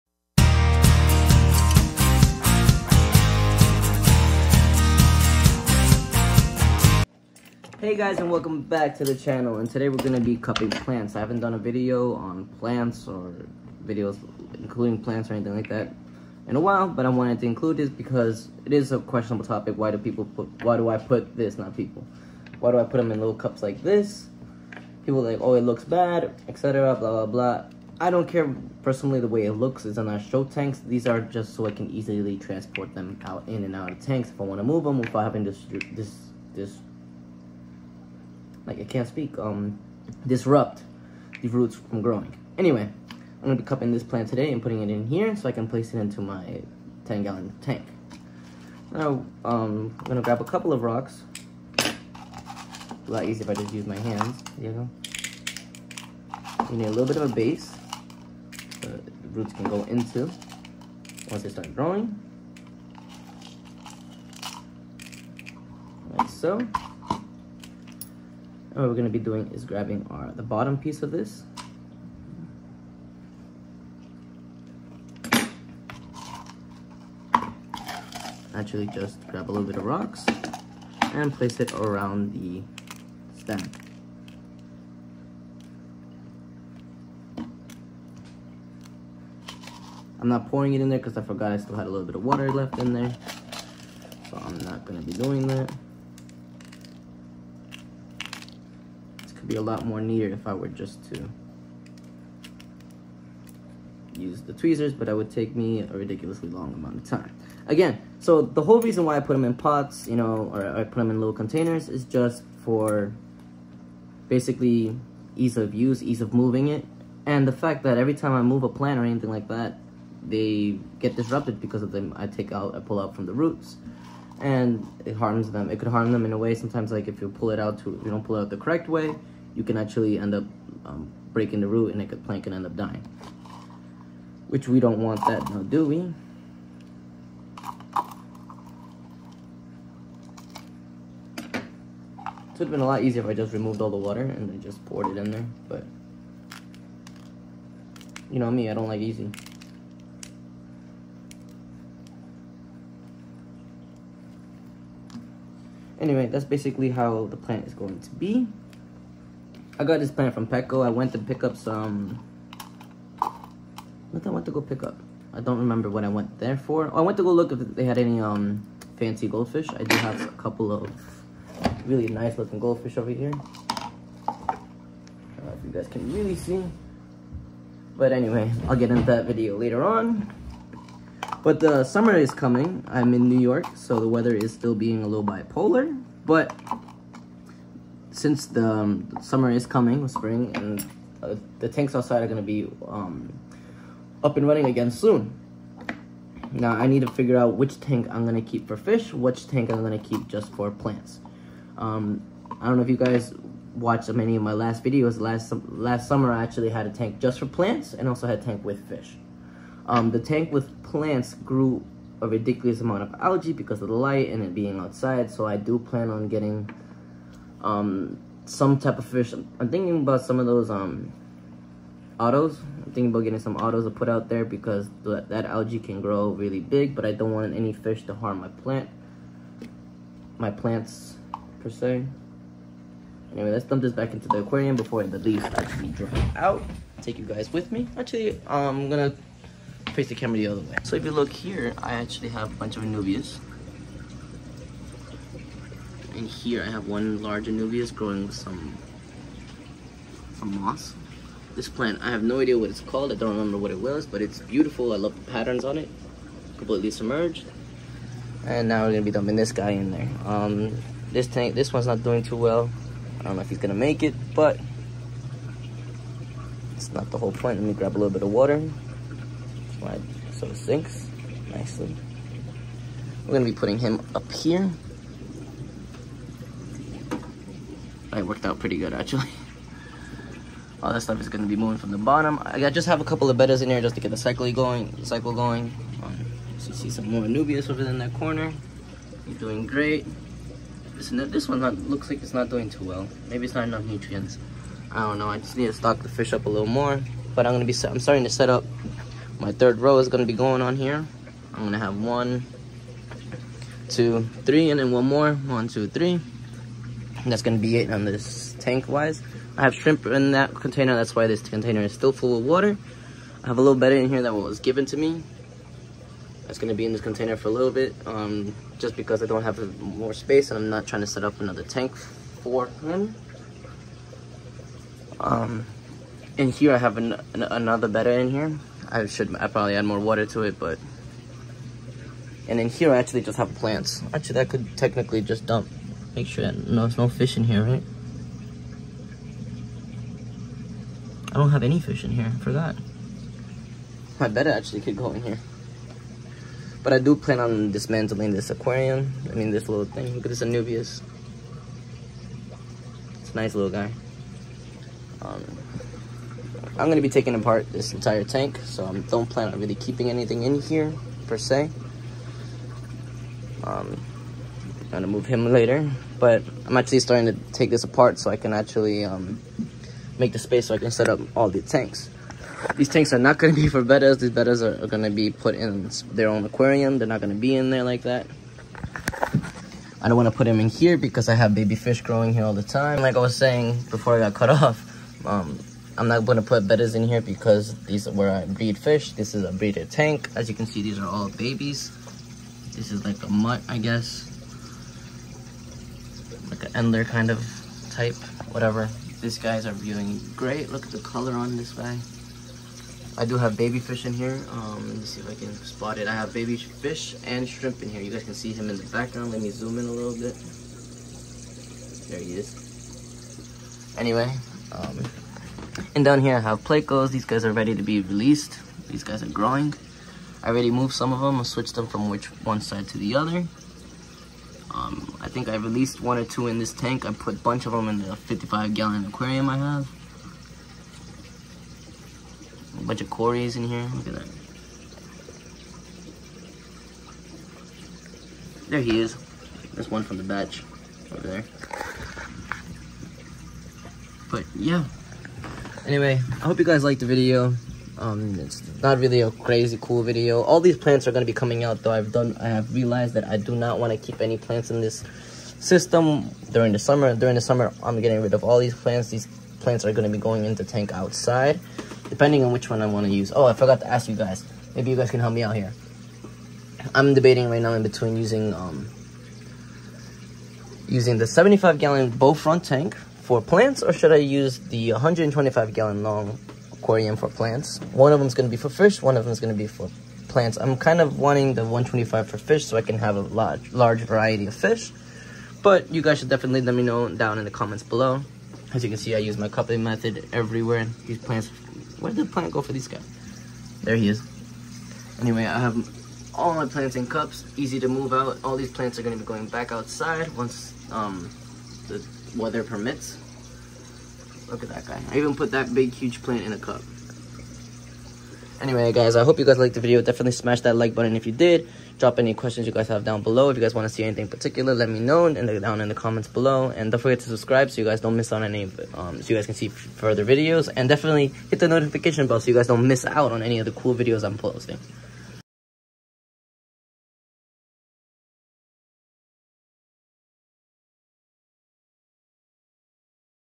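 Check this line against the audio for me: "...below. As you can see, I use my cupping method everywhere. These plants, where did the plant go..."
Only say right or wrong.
right.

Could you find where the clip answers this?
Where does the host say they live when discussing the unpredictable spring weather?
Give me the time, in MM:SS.
03:03.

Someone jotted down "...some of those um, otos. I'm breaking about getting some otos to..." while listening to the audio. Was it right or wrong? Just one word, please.
wrong.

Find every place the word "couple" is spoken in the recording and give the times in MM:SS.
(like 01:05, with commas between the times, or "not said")
00:50, 02:50, 04:43.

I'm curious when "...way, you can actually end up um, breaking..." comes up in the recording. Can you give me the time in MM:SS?
02:08.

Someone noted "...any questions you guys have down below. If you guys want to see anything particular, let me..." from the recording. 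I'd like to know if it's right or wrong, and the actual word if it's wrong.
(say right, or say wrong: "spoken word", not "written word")
right.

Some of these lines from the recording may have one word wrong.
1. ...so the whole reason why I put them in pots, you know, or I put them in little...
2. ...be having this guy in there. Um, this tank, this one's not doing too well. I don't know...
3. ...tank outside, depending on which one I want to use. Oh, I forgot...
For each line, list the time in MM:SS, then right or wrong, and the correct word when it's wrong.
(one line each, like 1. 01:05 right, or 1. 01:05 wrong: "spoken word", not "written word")
1. 01:48 right
2. 04:19 wrong: "dumping", not "having"
3. 07:40 right.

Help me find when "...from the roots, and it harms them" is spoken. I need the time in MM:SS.
02:03.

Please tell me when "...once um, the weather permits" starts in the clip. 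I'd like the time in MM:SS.
08:20.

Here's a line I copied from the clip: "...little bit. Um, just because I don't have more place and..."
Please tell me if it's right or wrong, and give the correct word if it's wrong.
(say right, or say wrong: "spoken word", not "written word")
wrong: "space", not "place".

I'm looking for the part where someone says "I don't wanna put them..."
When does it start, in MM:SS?
06:20.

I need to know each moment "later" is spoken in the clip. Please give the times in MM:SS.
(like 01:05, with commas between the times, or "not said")
02:59, 06:05.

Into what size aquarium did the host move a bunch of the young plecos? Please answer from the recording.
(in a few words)
55 gallon.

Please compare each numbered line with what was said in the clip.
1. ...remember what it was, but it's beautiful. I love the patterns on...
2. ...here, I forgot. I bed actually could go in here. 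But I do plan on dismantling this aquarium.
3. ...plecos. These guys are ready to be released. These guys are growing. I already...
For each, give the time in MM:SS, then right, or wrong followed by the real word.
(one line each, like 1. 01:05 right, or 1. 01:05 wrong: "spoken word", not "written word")
1. 04:13 right
2. 05:42 right
3. 06:56 right.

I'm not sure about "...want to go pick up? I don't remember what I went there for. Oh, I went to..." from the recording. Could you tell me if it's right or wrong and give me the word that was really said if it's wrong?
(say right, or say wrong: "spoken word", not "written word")
right.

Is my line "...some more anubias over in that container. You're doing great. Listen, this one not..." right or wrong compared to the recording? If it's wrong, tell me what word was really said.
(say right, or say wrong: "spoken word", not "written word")
wrong: "corner", not "container".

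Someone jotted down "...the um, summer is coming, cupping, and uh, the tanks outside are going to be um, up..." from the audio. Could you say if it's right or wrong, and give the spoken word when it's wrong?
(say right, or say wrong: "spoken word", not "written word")
wrong: "spring", not "cupping".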